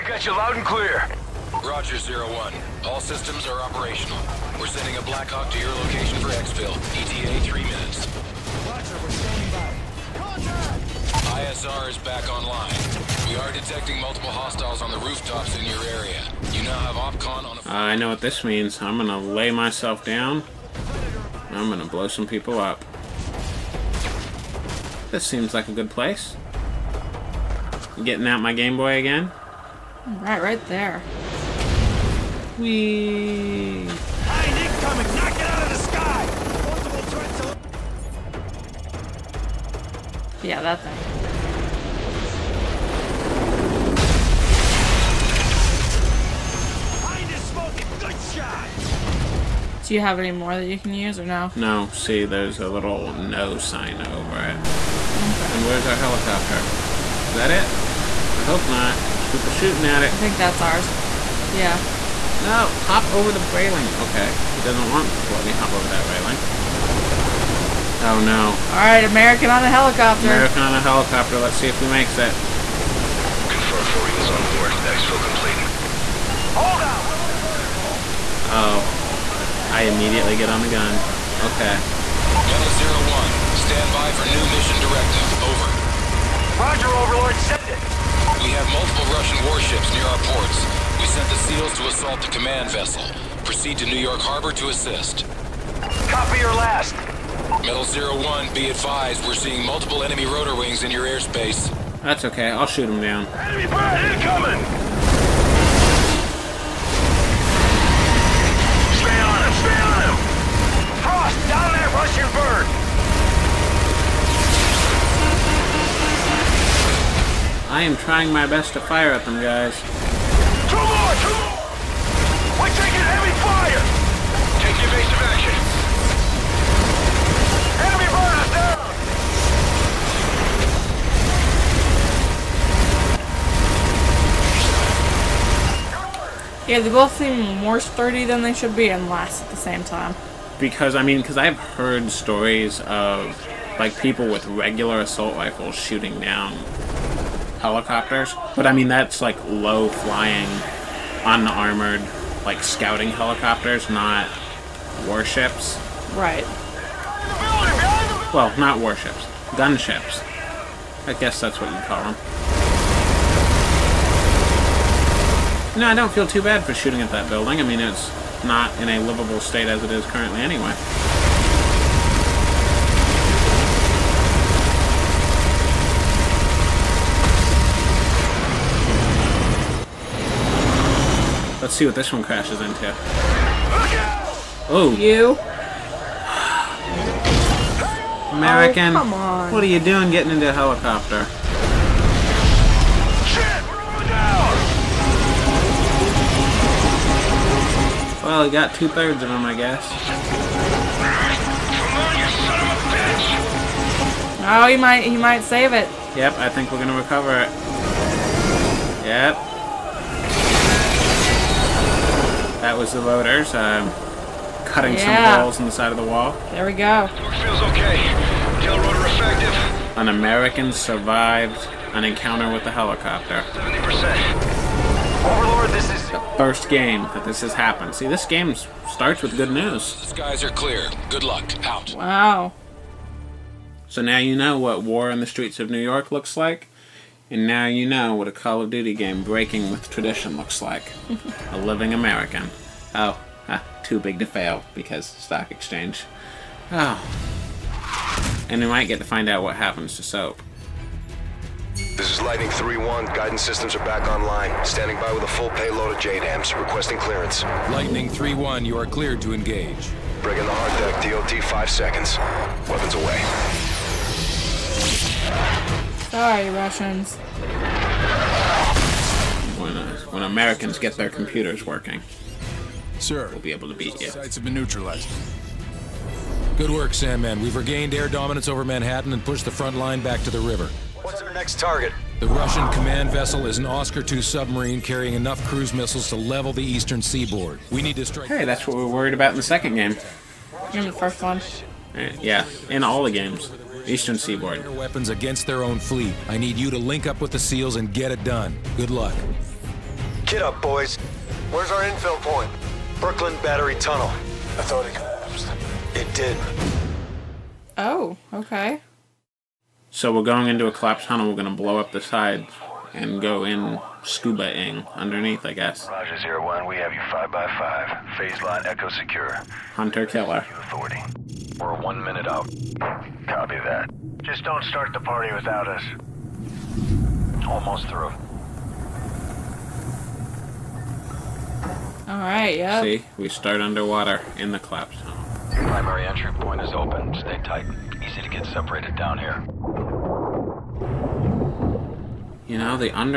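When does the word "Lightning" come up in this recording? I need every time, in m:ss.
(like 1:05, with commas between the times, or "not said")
4:12, 4:17.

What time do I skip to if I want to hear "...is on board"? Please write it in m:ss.
1:14.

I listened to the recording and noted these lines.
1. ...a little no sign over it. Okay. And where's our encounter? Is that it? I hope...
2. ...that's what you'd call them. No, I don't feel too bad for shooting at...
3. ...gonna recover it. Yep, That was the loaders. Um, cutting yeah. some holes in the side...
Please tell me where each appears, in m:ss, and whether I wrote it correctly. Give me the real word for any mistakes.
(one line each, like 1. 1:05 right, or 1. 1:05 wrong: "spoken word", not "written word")
1. 0:52 wrong: "helicopter", not "encounter"
2. 2:41 right
3. 3:26 right.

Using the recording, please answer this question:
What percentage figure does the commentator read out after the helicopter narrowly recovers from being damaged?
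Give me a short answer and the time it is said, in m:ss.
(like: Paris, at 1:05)
70%, at 3:43.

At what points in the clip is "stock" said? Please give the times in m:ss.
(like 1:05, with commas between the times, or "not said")
4:05.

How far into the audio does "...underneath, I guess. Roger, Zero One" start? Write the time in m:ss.
5:14.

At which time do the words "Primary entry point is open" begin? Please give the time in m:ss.
5:35.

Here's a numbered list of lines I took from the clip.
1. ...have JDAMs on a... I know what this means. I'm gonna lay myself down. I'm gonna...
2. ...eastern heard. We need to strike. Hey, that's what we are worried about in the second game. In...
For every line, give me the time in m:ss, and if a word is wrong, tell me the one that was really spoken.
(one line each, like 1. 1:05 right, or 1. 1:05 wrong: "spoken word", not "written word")
1. 0:16 wrong: "OPCON", not "JDAMs"
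2. 4:46 wrong: "seaboard", not "heard".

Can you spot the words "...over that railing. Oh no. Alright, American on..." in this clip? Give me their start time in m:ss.
1:05.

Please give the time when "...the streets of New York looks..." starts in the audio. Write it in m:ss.
3:55.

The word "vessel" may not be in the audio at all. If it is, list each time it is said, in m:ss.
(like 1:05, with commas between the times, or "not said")
1:32, 4:43.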